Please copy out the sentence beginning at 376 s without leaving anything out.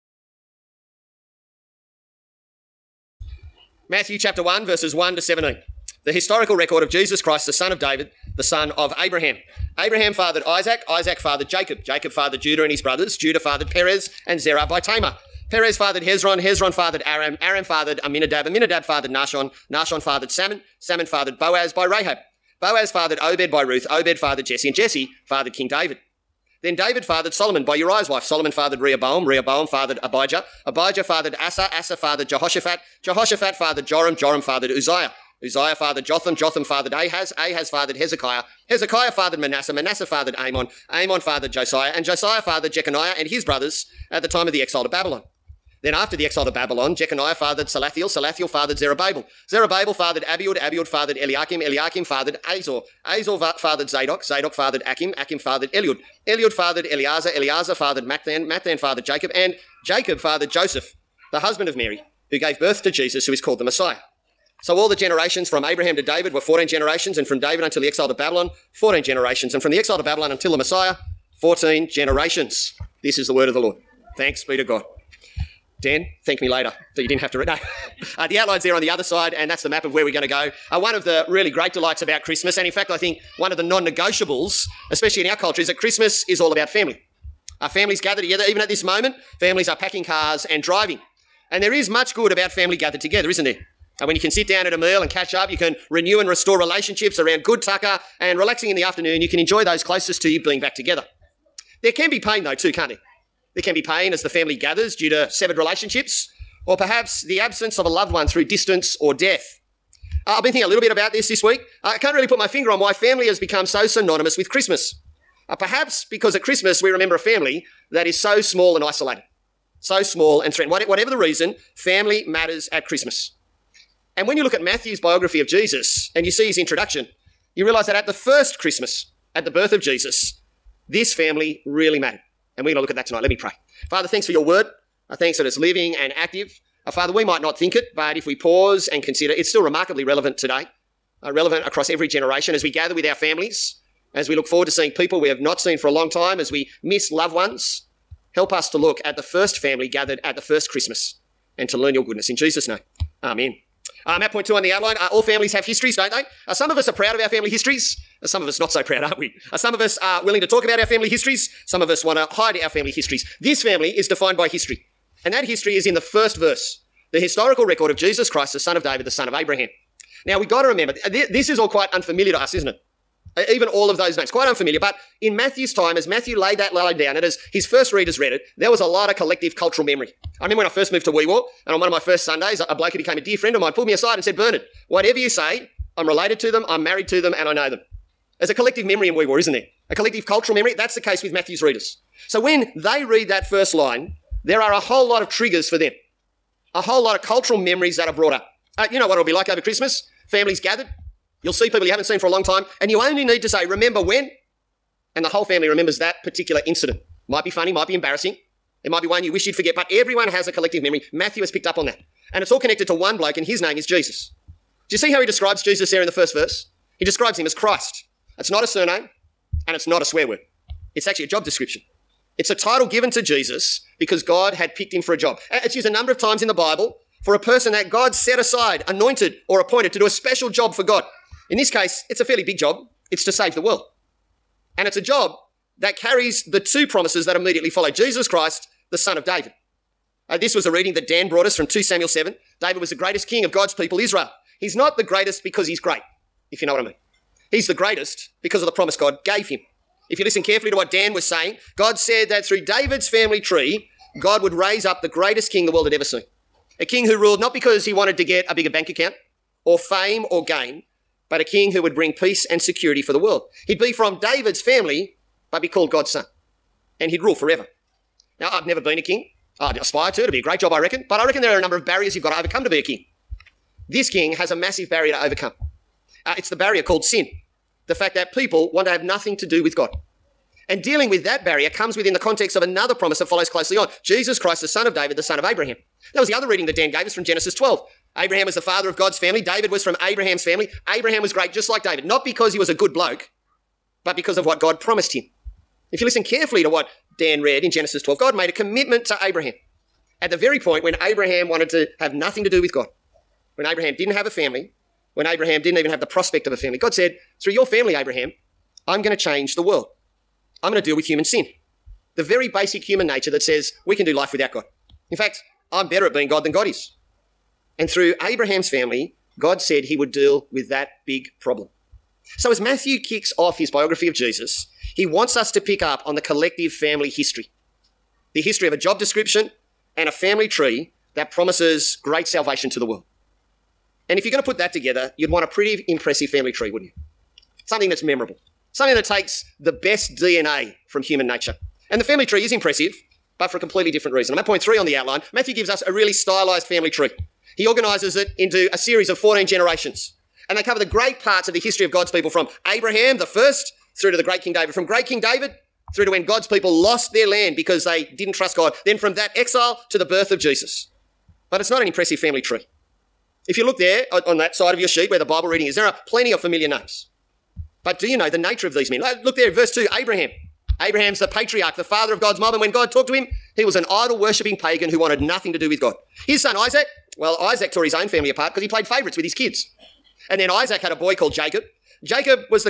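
His son Isaac, well, Isaac tore his own family apart because he played favourites with his kids.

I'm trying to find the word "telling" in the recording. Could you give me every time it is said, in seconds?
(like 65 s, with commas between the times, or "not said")
not said.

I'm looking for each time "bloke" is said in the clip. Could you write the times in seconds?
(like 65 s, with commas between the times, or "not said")
182 s, 213 s, 292 s.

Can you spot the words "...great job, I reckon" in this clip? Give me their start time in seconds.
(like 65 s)
270 s.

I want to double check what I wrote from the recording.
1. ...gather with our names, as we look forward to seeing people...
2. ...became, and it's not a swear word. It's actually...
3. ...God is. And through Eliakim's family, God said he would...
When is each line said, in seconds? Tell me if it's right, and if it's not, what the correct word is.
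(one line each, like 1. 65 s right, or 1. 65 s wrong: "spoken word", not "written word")
1. 142 s wrong: "families", not "names"
2. 218 s wrong: "surname", not "became"
3. 316 s wrong: "Abraham", not "Eliakim".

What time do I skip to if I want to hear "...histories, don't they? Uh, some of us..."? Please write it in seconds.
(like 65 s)
155 s.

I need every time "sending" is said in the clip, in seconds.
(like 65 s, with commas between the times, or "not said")
not said.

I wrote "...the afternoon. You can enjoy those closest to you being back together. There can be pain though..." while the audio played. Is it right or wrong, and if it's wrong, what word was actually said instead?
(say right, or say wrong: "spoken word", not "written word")
right.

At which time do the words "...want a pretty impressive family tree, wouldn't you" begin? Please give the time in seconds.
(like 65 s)
335 s.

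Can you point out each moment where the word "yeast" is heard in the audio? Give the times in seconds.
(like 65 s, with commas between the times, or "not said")
not said.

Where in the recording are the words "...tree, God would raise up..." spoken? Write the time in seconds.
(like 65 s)
253 s.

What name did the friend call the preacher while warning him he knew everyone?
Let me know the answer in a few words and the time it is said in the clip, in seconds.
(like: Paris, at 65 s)
Bernard, at 184 s.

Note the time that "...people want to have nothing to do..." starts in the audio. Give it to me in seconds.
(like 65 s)
278 s.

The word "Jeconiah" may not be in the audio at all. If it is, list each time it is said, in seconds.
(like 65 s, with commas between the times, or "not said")
42 s, 46 s.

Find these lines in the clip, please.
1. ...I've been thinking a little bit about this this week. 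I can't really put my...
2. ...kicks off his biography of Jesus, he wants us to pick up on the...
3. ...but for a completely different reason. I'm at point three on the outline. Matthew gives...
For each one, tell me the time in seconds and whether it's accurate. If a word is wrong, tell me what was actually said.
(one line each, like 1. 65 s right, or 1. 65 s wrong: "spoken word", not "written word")
1. 110 s right
2. 323 s right
3. 343 s right.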